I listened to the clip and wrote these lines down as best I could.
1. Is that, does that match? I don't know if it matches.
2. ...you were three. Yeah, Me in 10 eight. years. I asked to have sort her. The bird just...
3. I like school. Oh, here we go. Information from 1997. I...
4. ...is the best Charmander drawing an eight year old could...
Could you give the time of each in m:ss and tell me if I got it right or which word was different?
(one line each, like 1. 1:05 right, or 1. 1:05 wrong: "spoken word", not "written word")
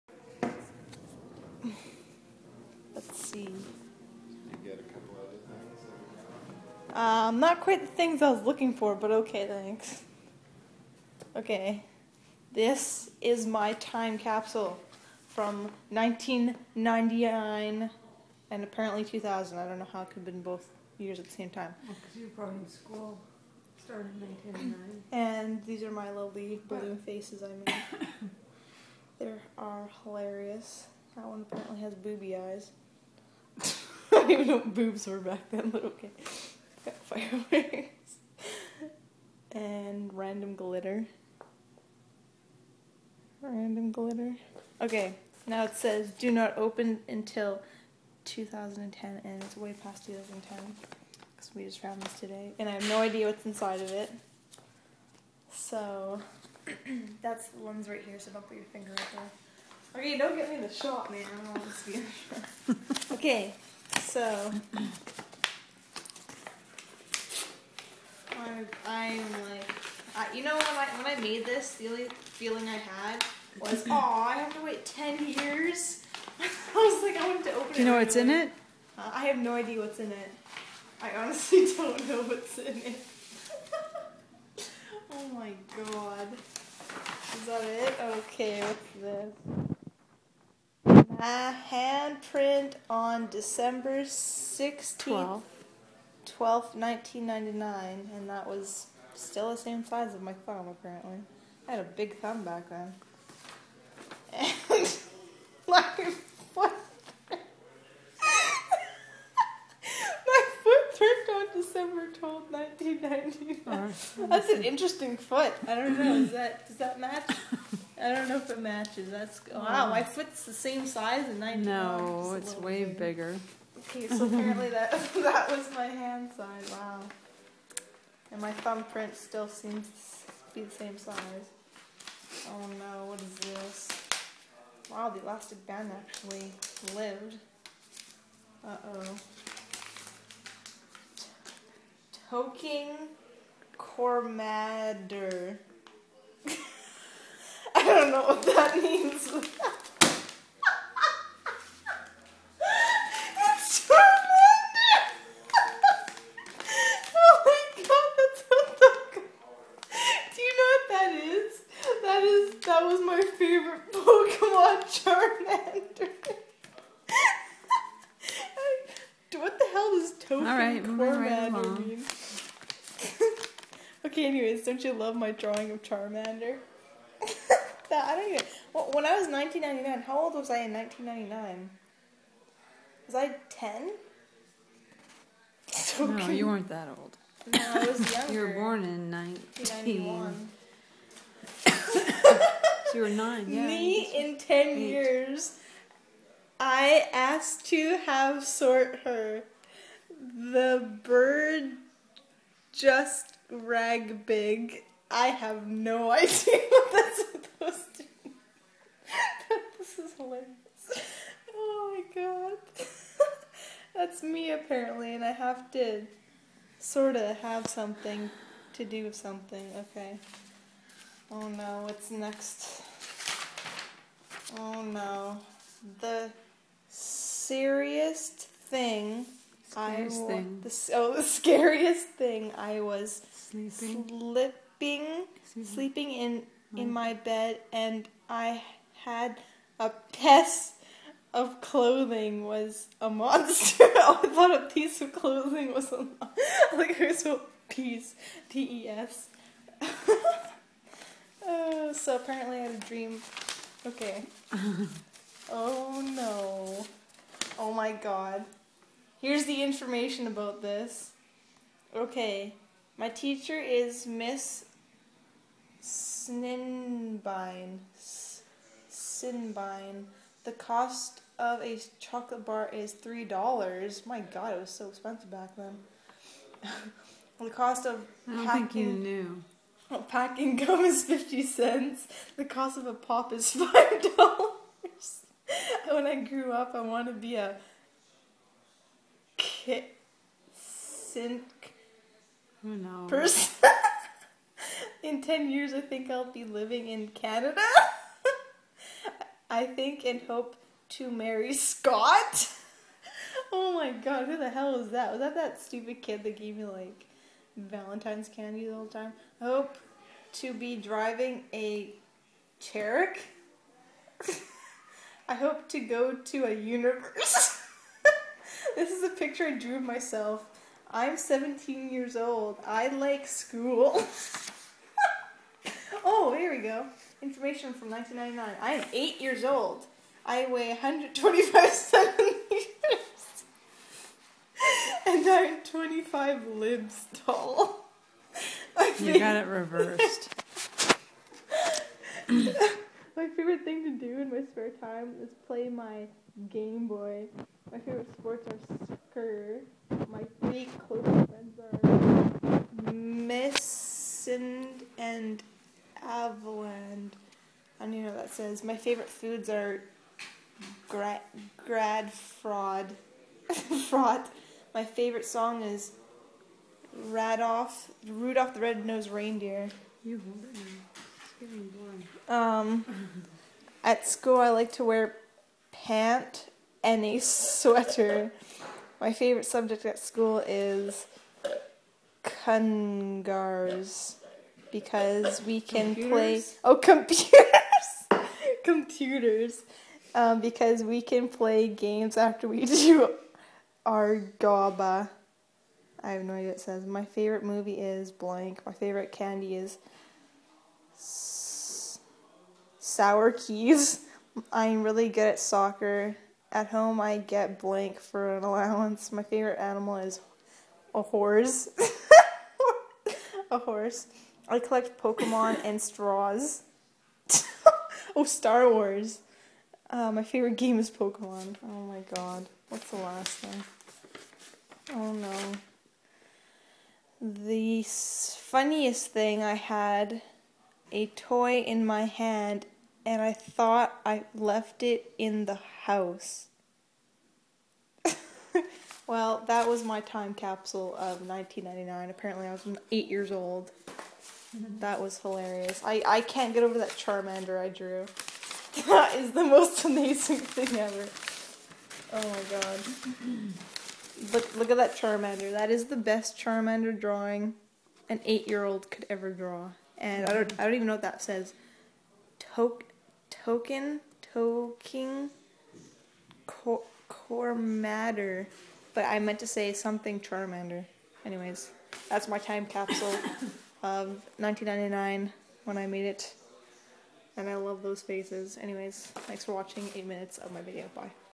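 1. 1:56 right
2. 3:12 wrong: "nine", not "three"
3. 5:22 wrong: "1999", not "1997"
4. 7:35 right.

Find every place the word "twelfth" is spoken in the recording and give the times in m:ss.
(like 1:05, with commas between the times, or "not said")
1:52.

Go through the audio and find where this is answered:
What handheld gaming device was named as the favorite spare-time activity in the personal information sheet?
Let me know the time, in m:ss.
5:46.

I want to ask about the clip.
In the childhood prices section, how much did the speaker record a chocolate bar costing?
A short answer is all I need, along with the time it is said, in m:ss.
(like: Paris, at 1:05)
3 dollars, at 4:32.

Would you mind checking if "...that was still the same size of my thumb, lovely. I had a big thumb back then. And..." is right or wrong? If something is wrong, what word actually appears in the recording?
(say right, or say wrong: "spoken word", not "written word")
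wrong: "apparently", not "lovely".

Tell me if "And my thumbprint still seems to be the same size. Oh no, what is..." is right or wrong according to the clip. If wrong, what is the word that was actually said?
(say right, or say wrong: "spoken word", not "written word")
right.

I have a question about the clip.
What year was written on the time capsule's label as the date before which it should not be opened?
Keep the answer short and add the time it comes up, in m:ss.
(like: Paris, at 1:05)
2010, at 0:46.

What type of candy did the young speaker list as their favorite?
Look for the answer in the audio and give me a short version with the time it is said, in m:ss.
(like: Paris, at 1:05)
Sour keys, at 6:42.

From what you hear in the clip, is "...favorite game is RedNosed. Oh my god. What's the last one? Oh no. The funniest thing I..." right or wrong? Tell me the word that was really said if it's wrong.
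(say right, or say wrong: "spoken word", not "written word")
wrong: "Pokemon", not "RedNosed".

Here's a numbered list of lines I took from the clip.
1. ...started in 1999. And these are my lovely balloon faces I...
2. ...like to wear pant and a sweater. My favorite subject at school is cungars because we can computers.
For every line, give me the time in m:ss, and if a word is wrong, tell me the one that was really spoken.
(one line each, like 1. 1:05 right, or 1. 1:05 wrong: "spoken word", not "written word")
1. 0:23 right
2. 6:14 right.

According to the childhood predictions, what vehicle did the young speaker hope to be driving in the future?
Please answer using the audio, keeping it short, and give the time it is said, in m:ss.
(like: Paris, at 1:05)
Cherokee, at 5:12.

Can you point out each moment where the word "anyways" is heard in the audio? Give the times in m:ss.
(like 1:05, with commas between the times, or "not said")
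2:54, 7:51, 7:58.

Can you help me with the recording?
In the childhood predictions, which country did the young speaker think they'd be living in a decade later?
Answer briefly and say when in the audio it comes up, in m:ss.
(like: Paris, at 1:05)
Canada, at 4:57.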